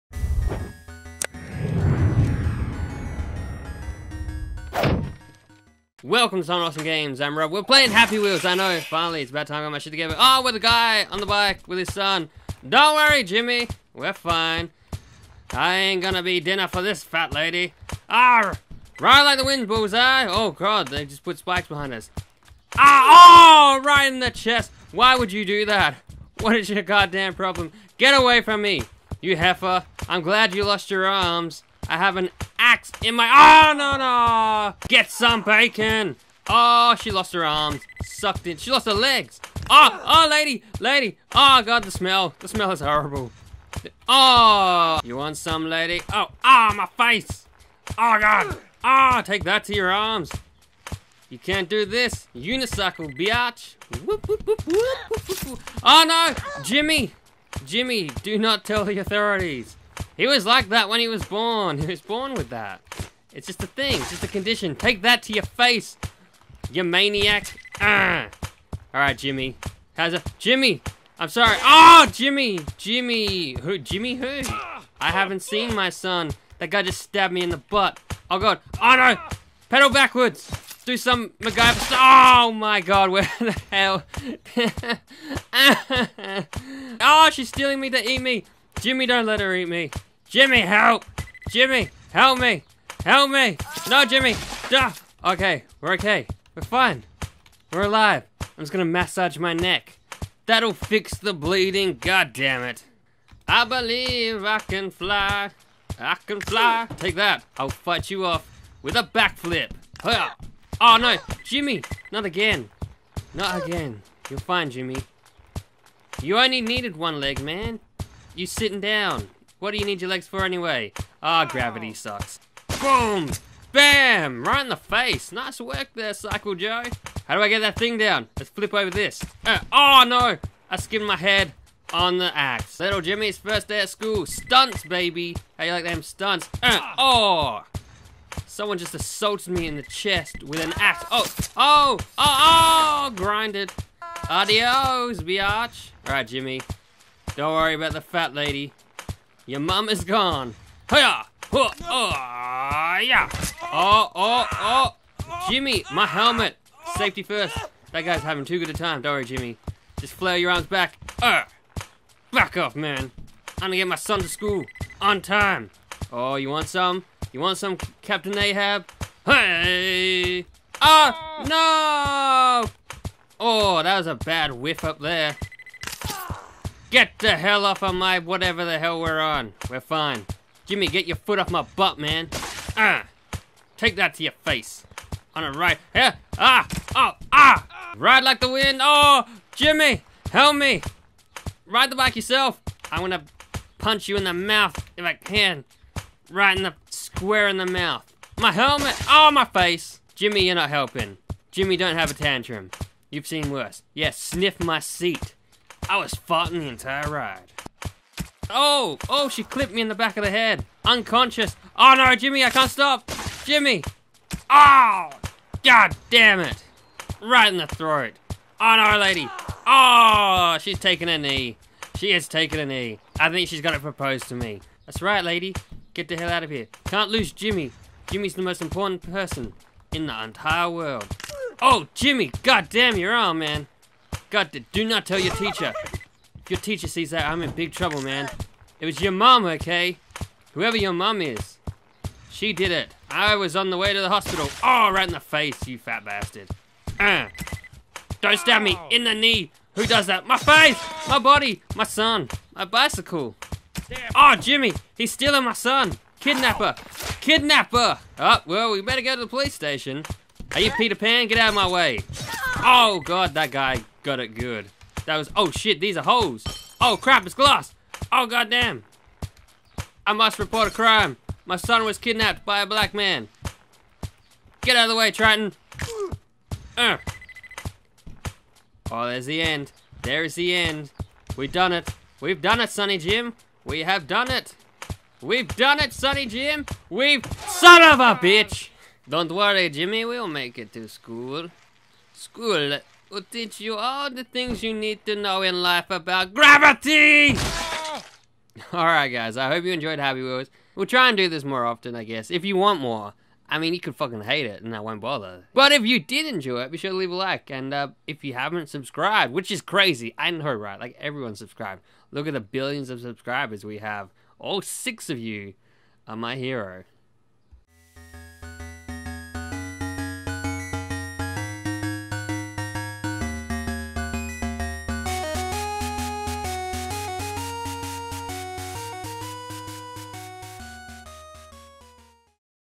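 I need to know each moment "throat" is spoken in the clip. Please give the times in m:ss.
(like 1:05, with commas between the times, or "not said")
3:37.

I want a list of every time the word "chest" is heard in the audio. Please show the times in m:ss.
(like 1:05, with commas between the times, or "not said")
0:24, 2:19.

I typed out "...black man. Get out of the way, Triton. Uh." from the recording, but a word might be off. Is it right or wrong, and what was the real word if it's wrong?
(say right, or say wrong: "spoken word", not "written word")
right.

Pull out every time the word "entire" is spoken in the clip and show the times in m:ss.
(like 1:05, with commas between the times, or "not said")
3:26, 3:50.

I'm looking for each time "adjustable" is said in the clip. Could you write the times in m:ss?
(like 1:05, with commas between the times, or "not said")
not said.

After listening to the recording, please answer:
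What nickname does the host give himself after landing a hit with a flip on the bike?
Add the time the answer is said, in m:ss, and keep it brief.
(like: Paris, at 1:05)
Cycle Joe, at 2:06.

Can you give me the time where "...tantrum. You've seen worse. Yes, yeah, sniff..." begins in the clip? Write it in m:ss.
3:22.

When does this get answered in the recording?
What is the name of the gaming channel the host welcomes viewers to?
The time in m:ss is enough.
0:06.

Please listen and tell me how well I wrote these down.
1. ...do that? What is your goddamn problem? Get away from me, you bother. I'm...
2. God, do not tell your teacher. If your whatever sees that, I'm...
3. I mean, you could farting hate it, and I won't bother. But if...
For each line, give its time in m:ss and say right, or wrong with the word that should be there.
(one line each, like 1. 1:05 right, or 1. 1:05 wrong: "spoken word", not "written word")
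1. 0:25 wrong: "heifer", not "bother"
2. 3:54 wrong: "teacher", not "whatever"
3. 5:03 wrong: "fucking", not "farting".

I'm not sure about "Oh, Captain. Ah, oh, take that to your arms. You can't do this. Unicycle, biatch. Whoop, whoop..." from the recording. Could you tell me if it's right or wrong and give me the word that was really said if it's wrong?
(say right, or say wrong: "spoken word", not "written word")
wrong: "God", not "Captain".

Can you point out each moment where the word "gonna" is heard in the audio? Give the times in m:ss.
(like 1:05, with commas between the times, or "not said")
0:16, 1:38, 2:43, 3:12.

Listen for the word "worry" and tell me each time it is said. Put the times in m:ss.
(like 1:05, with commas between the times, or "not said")
0:12, 2:27, 2:39, 4:49.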